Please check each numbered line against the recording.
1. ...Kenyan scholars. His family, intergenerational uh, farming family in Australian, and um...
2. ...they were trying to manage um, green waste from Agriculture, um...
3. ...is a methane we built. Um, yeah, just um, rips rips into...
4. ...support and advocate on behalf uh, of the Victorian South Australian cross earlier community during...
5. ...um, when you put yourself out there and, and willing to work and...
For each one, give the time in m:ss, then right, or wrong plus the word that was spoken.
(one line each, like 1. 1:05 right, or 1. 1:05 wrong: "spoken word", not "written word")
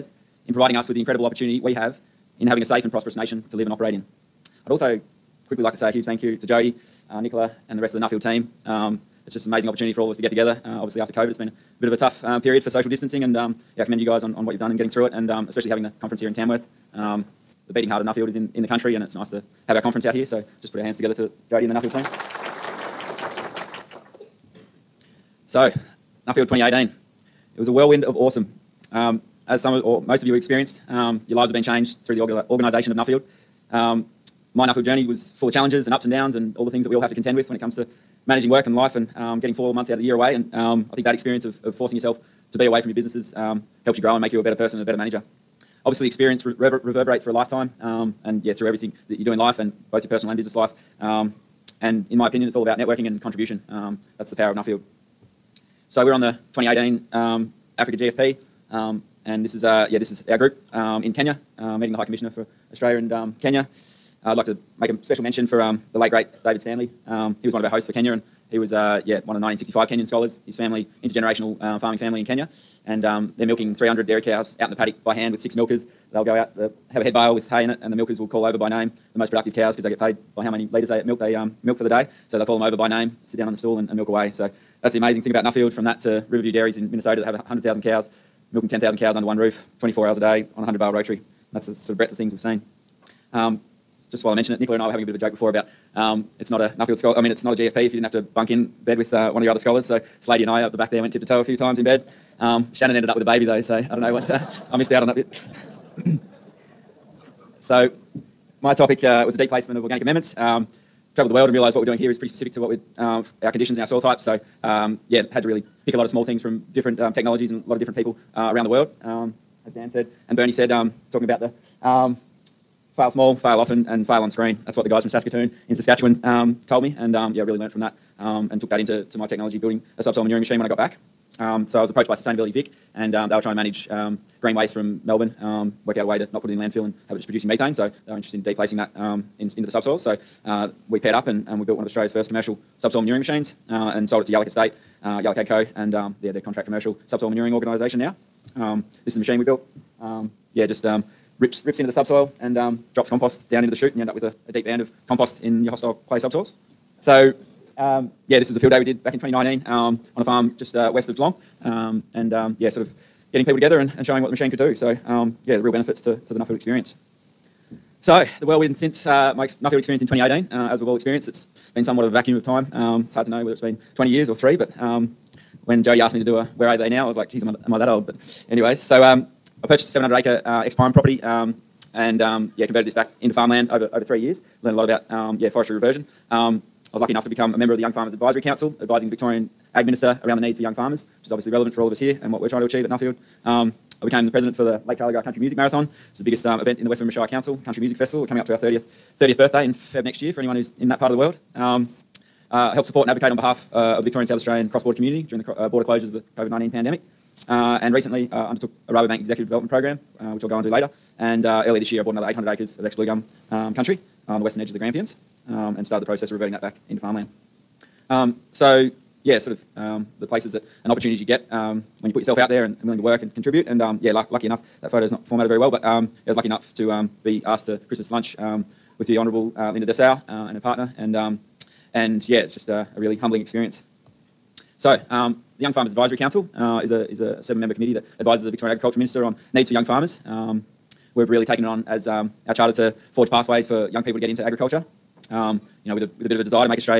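1. 1:09 wrong: "Kenya", not "Australian"
2. 2:13 wrong: "Melbourne", not "Agriculture"
3. 2:29 wrong: "machine", not "methane"
4. 3:22 wrong: "border", not "earlier"
5. 3:41 right.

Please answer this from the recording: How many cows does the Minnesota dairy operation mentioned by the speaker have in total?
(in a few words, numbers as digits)
100,000.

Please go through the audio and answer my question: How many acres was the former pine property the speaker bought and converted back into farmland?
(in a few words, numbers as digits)
700.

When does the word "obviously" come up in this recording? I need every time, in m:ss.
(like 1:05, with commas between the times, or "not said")
0:10, 0:45, 3:11.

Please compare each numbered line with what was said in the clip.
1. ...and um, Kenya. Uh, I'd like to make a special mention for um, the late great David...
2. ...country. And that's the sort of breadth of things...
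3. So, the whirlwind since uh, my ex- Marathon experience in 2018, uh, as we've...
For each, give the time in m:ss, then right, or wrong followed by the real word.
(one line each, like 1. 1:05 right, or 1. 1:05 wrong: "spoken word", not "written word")
1. 1:02 right
2. 1:30 wrong: "rotary", not "country"
3. 2:48 wrong: "Nuffield", not "Marathon".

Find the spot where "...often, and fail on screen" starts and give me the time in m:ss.
2:03.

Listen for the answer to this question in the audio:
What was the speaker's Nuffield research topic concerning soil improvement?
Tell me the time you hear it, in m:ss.
1:49.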